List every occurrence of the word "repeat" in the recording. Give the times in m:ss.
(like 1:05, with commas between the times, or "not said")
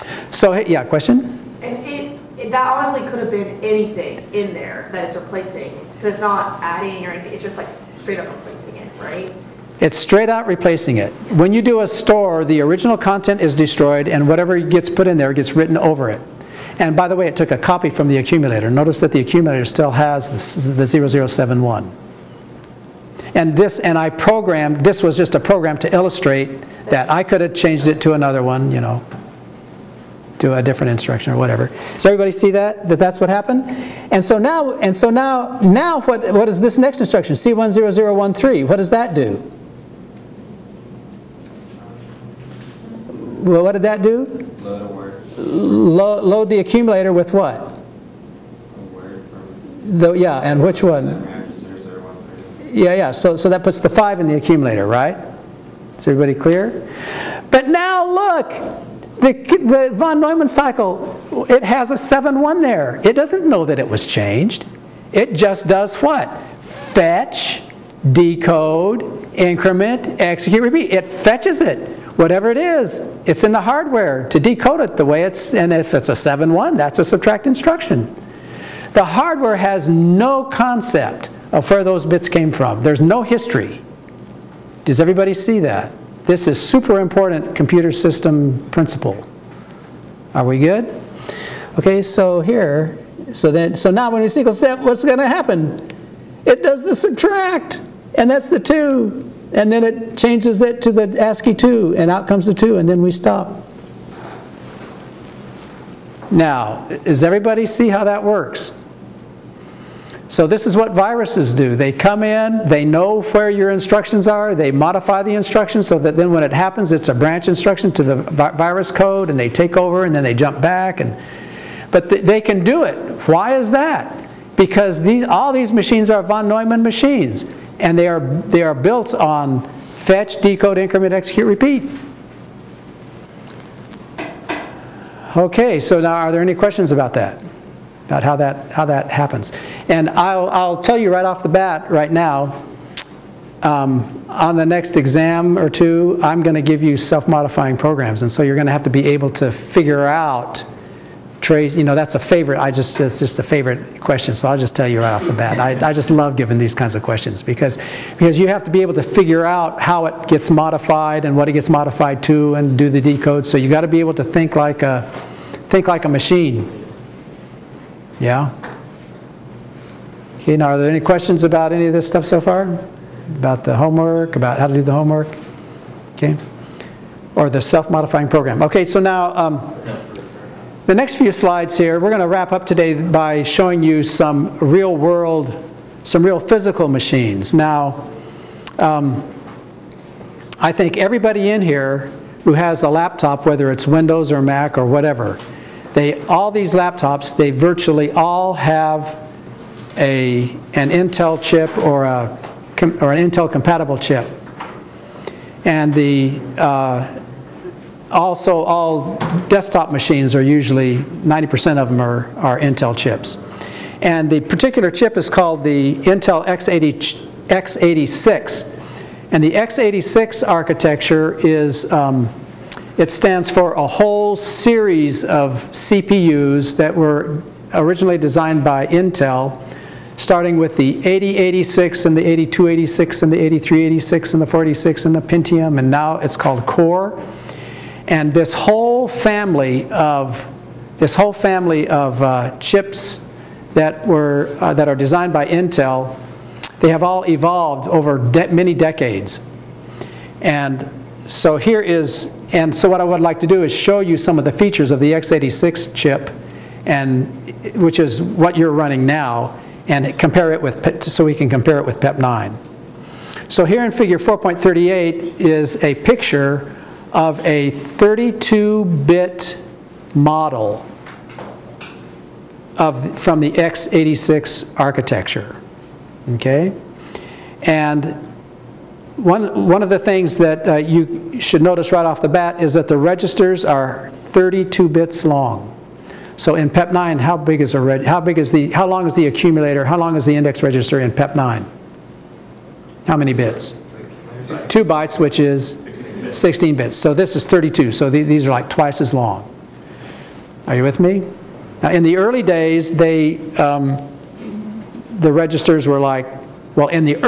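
1:10, 2:11.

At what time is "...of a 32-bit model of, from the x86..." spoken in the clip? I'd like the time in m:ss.
4:27.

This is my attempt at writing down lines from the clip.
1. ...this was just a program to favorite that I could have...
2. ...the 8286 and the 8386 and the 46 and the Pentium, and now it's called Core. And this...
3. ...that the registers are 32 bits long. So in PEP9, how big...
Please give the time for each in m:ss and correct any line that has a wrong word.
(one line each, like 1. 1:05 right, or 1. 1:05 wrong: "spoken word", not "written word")
1. 0:24 wrong: "illustrate", not "favorite"
2. 3:52 right
3. 4:42 right.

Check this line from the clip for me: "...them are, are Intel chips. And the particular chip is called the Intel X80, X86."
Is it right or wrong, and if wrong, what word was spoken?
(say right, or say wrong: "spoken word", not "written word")
right.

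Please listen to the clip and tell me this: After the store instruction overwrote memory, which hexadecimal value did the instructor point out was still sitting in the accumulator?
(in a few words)
0071.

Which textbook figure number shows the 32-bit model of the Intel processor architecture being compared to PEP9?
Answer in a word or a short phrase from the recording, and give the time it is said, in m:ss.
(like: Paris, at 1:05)
4.38, at 4:23.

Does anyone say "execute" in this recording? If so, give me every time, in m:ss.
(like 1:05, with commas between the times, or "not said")
1:10, 2:11.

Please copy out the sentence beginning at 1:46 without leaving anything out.
Now, does everybody see how that works?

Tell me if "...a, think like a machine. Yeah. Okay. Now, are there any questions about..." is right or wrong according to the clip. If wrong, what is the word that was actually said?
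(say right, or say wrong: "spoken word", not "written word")
right.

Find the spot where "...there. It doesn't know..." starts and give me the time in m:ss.
1:02.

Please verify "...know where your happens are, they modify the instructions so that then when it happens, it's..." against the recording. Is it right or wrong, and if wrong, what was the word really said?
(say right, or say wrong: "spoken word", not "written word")
wrong: "instructions", not "happens".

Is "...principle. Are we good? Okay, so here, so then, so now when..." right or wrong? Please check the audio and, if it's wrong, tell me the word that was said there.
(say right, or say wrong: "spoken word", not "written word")
right.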